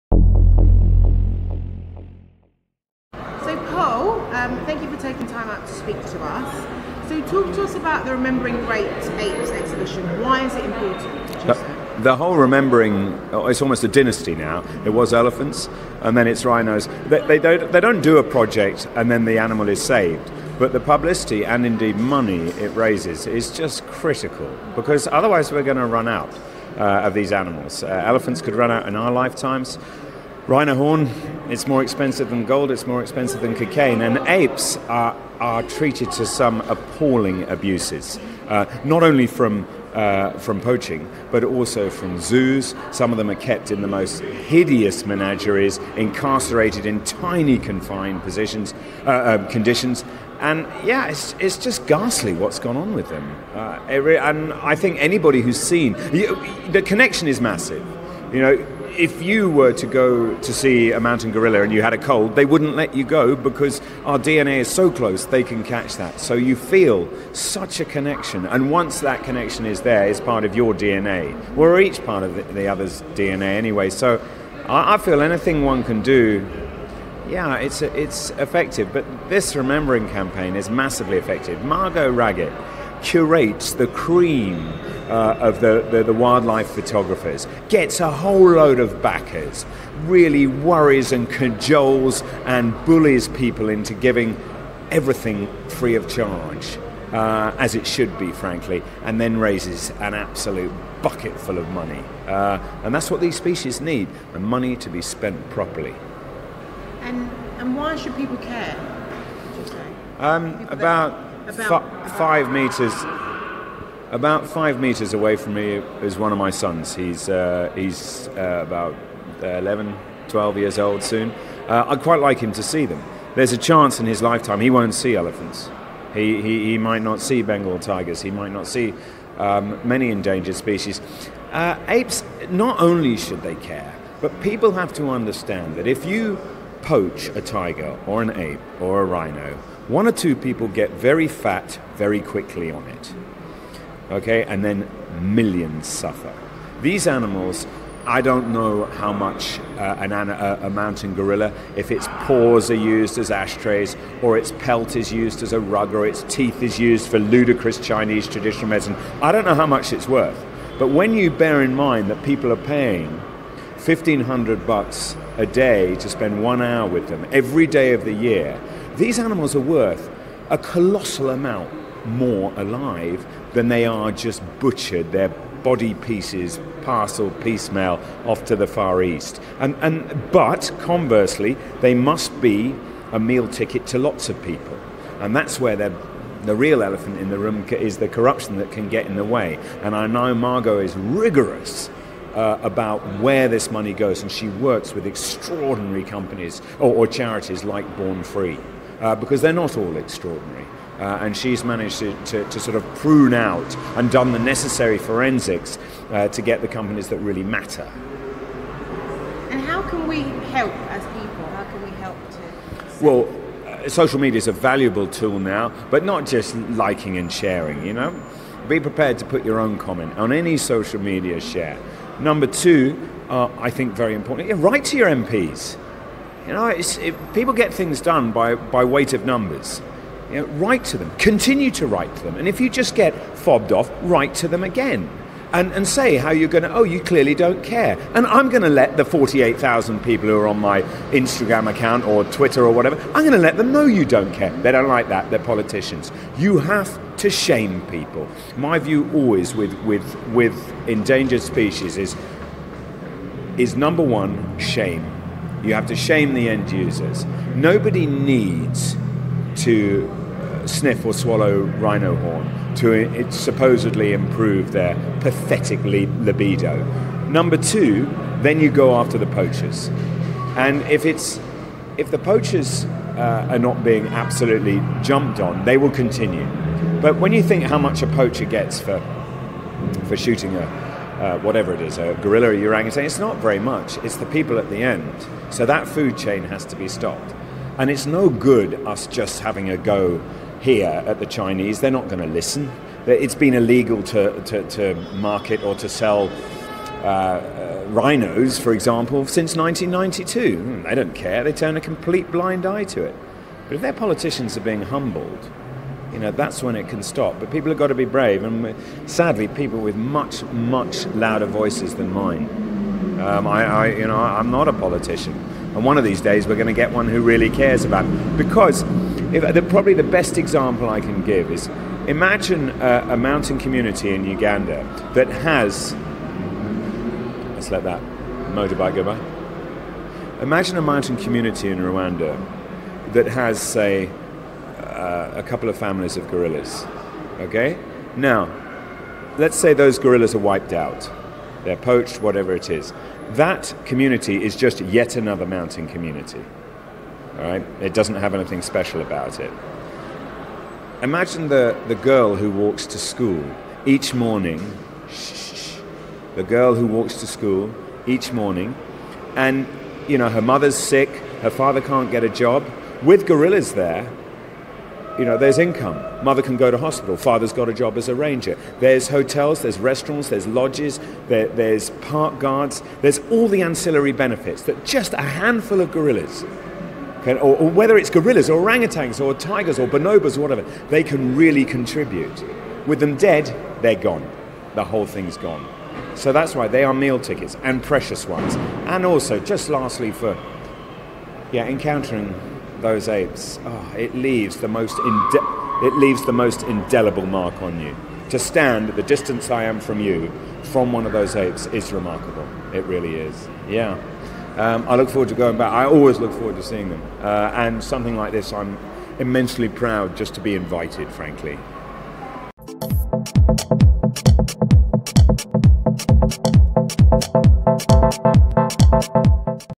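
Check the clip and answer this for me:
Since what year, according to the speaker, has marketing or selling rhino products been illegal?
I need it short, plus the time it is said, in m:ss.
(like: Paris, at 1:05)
1992, at 4:59.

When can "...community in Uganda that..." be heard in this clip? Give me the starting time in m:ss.
5:23.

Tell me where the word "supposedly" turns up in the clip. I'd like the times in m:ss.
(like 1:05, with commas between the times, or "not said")
4:23.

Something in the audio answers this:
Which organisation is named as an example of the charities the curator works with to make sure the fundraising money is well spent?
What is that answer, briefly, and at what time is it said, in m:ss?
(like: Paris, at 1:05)
Born Free, at 3:17.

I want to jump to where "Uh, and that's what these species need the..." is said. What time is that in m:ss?
1:42.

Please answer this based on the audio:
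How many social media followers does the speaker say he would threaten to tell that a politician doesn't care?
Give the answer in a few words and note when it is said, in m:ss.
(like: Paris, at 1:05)
48,000, at 3:59.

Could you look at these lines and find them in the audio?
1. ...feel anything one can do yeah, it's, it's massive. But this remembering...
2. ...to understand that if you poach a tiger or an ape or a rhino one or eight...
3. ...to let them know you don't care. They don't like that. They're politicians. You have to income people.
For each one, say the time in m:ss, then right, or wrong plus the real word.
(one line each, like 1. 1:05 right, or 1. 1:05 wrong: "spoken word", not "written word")
1. 1:14 wrong: "effective", not "massive"
2. 2:14 wrong: "two", not "eight"
3. 4:03 wrong: "shame", not "income".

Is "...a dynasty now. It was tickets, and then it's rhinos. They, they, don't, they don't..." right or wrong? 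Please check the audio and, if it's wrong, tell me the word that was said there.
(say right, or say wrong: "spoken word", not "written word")
wrong: "elephants", not "tickets".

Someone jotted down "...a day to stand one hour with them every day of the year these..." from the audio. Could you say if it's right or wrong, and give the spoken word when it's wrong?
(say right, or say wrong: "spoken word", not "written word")
wrong: "spend", not "stand".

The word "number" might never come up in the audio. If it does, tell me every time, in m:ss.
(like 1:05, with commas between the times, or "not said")
3:42, 3:49, 4:13, 4:27.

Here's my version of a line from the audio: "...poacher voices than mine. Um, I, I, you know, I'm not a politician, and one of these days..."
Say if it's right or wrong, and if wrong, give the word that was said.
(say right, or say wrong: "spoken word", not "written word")
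wrong: "louder", not "poacher".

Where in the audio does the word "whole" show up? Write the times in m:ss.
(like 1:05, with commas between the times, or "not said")
0:12, 1:28, 6:24.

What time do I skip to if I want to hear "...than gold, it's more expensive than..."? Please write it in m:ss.
0:32.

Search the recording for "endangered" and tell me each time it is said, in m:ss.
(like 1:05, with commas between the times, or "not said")
2:10, 4:10.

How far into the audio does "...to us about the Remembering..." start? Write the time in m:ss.
0:07.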